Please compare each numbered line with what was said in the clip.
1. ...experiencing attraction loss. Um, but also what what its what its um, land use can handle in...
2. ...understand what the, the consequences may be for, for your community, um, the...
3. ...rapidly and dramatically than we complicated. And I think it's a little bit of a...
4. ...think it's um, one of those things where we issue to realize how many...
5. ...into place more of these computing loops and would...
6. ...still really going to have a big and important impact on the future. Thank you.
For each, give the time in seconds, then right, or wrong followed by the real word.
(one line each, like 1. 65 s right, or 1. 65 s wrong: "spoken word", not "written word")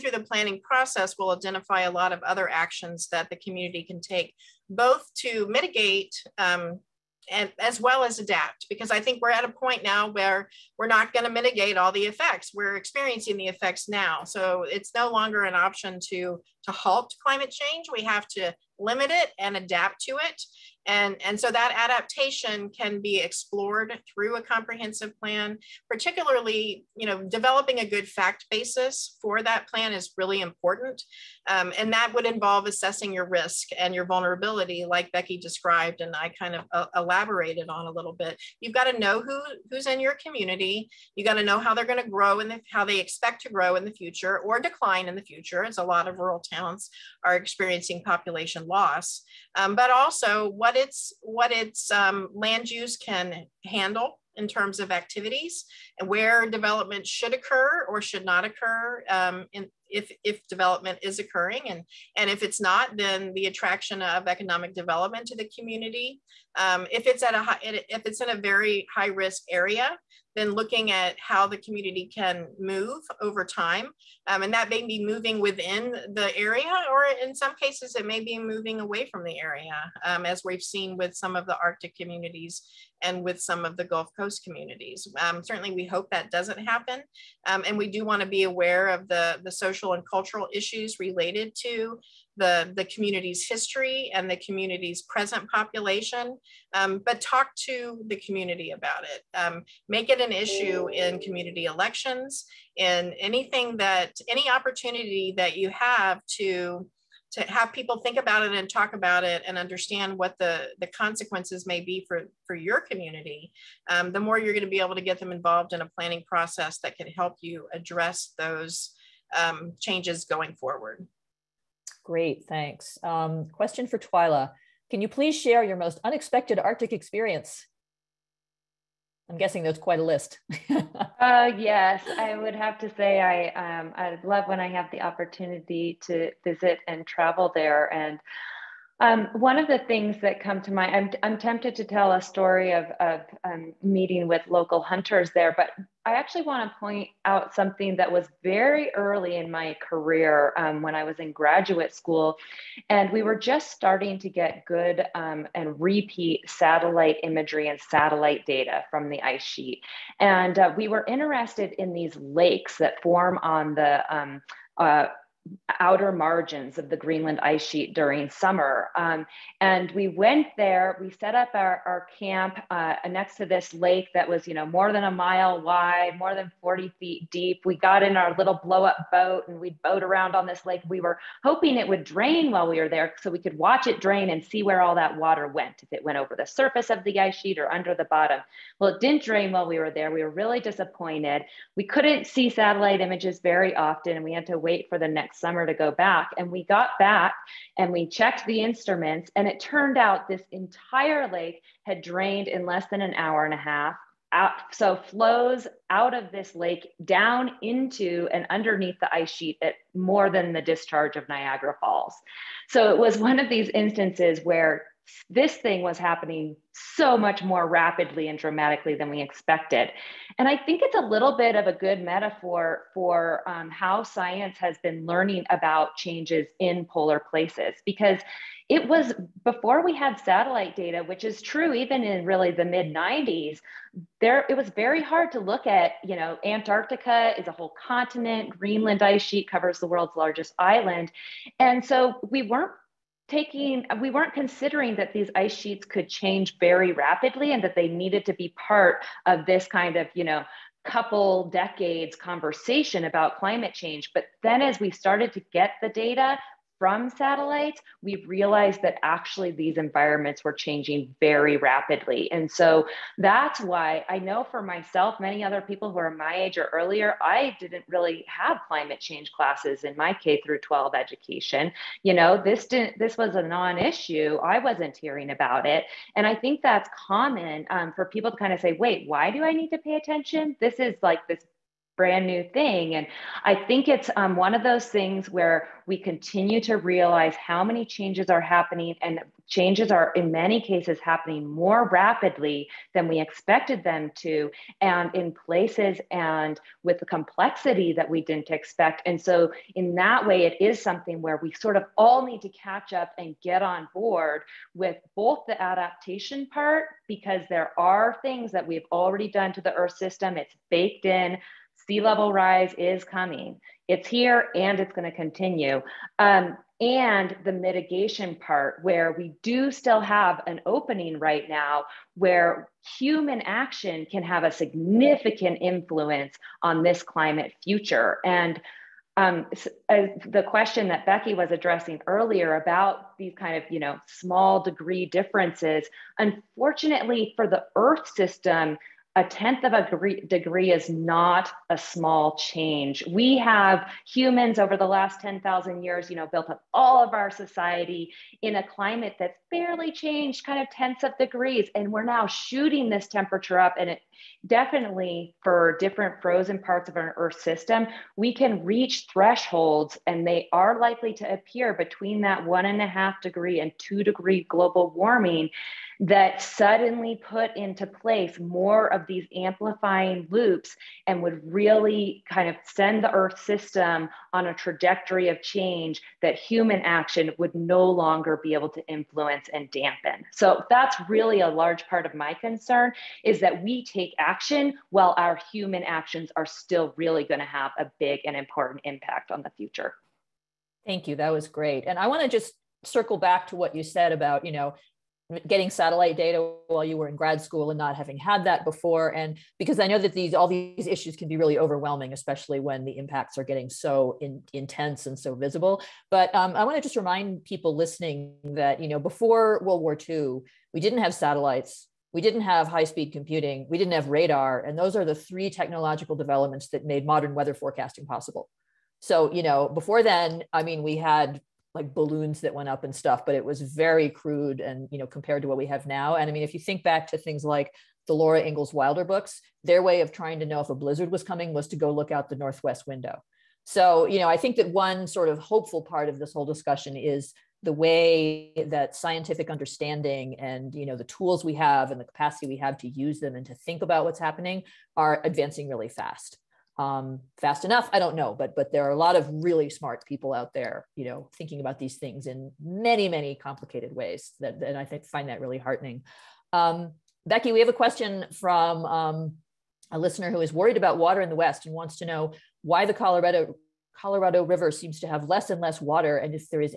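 1. 47 s wrong: "population", not "attraction"
2. 109 s right
3. 217 s wrong: "expected", not "complicated"
4. 283 s wrong: "continue", not "issue"
5. 367 s wrong: "amplifying", not "computing"
6. 386 s right.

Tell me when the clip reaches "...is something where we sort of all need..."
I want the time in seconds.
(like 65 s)
300 s.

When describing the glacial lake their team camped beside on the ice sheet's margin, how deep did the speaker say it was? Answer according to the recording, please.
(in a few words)
more than 40 feet.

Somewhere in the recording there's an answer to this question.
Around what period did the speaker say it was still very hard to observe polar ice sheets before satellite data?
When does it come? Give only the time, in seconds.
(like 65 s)
232 s.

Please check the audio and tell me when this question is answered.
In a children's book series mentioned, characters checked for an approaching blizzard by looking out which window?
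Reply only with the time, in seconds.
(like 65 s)
432 s.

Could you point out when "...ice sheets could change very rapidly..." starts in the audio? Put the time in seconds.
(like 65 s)
245 s.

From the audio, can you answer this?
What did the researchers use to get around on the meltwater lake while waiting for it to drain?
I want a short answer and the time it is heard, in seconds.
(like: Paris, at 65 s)
little blow up boat, at 178 s.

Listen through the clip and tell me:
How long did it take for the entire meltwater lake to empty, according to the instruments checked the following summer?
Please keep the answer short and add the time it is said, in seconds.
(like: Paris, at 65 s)
less than an hour and a half, at 202 s.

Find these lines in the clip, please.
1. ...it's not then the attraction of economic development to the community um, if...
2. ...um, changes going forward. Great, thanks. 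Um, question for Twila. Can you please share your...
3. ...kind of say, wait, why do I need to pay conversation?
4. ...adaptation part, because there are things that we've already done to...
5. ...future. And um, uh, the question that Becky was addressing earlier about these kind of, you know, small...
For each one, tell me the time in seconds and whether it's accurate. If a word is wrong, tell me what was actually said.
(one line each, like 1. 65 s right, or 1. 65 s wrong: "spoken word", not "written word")
1. 62 s right
2. 119 s right
3. 278 s wrong: "attention", not "conversation"
4. 305 s right
5. 327 s right.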